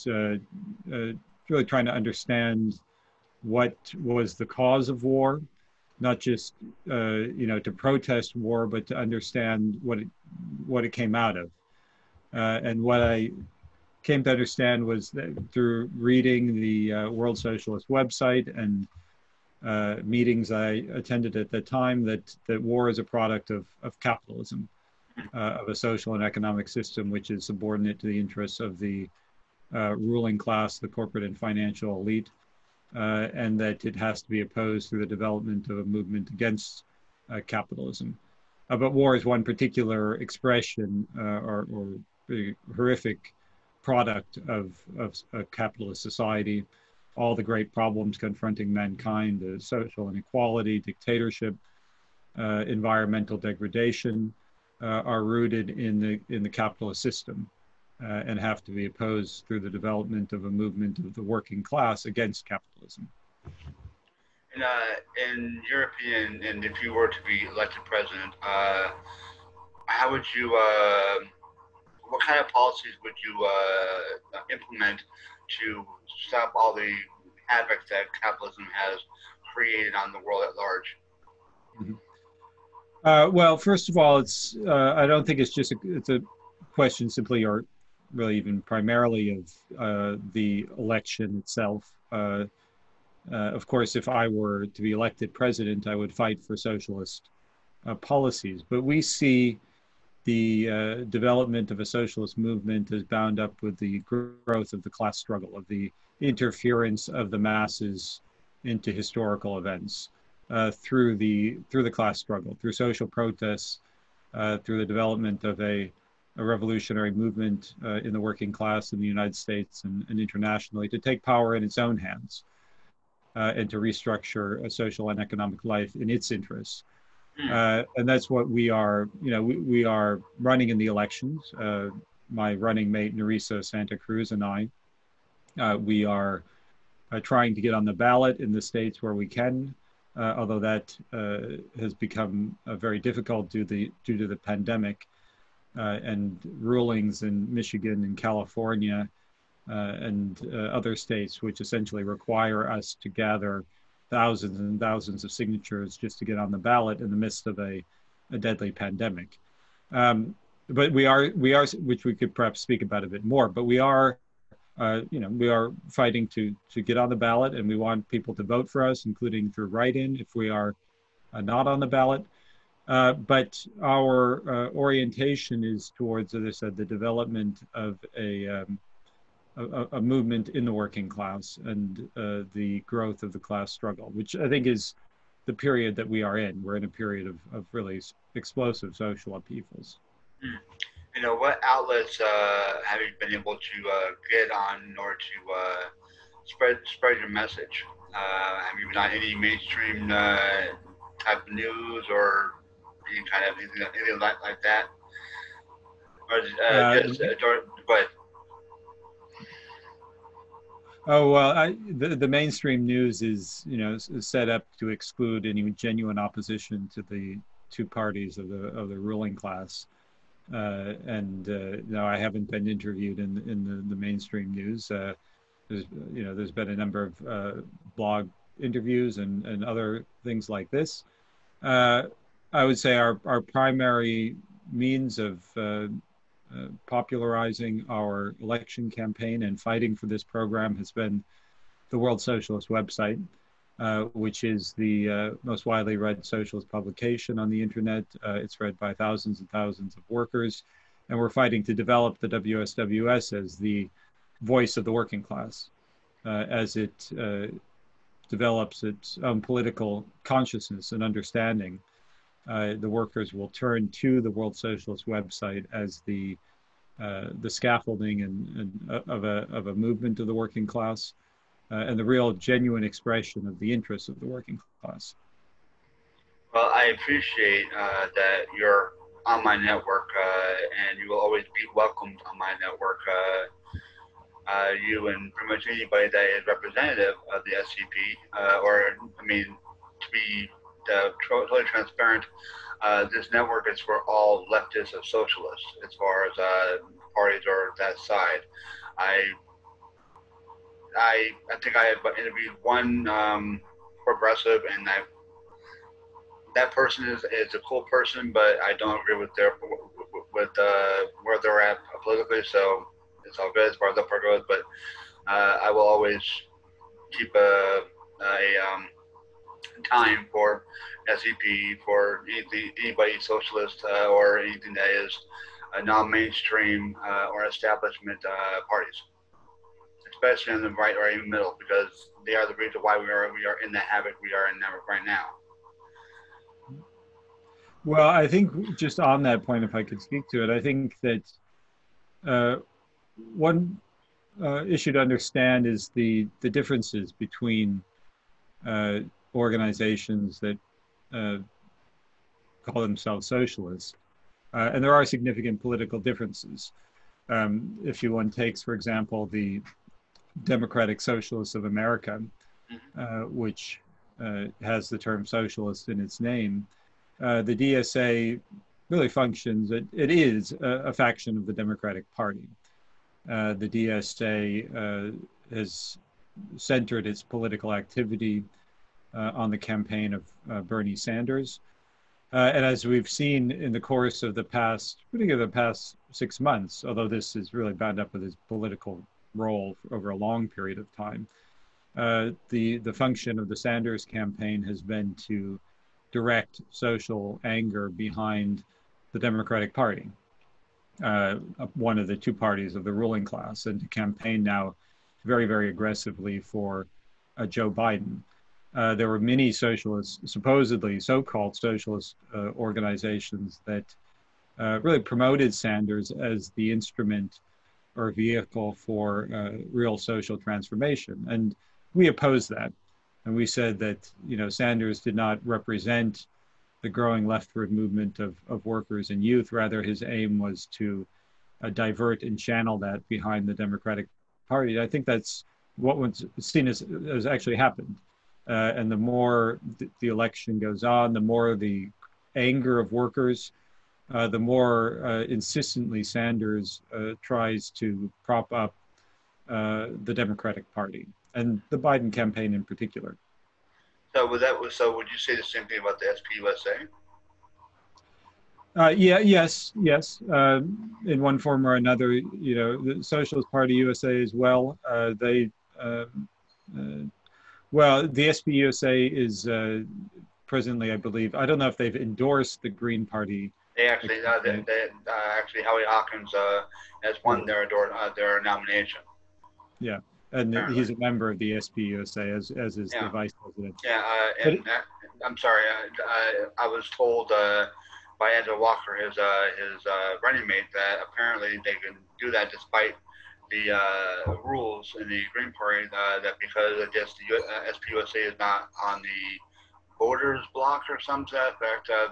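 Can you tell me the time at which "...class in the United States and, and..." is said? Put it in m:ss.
1:58.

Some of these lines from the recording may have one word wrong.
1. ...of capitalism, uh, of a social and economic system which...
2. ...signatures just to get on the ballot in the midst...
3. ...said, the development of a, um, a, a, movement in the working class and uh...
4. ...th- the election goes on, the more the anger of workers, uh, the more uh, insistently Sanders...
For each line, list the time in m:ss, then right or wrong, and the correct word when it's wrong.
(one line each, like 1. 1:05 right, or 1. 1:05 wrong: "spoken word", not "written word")
1. 0:23 right
2. 2:35 right
3. 2:56 right
4. 7:19 right.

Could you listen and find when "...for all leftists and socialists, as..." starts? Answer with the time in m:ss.
4:53.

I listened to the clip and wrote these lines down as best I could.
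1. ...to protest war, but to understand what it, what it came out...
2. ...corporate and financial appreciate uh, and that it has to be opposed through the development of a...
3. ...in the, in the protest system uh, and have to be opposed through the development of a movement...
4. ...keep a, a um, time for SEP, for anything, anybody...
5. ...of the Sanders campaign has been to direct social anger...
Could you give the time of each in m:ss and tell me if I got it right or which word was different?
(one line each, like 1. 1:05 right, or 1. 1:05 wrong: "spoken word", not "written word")
1. 0:07 right
2. 0:30 wrong: "elite", not "appreciate"
3. 0:55 wrong: "capitalist", not "protest"
4. 5:17 right
5. 6:33 right.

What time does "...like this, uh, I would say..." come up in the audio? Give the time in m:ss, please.
3:50.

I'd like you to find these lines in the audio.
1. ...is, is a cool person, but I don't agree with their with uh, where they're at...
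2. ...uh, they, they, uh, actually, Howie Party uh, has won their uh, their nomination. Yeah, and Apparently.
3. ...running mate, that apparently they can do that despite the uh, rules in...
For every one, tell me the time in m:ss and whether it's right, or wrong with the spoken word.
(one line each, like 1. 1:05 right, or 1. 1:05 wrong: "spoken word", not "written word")
1. 5:07 right
2. 7:54 wrong: "Hawkins", not "Party"
3. 8:10 right.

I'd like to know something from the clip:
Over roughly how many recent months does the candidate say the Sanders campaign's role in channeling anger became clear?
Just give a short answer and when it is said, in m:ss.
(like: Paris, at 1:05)
6 months, at 6:26.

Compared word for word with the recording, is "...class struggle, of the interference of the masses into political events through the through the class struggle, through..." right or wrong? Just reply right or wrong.
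wrong.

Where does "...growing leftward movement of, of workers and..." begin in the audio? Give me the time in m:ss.
7:06.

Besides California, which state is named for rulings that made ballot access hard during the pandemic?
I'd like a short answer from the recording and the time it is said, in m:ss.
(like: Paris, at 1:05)
Michigan, at 2:27.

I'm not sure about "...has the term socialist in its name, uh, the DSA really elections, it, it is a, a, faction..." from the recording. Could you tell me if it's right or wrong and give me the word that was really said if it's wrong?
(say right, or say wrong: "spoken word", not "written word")
wrong: "functions", not "elections".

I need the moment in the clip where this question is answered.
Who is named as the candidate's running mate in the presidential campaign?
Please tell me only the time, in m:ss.
2:13.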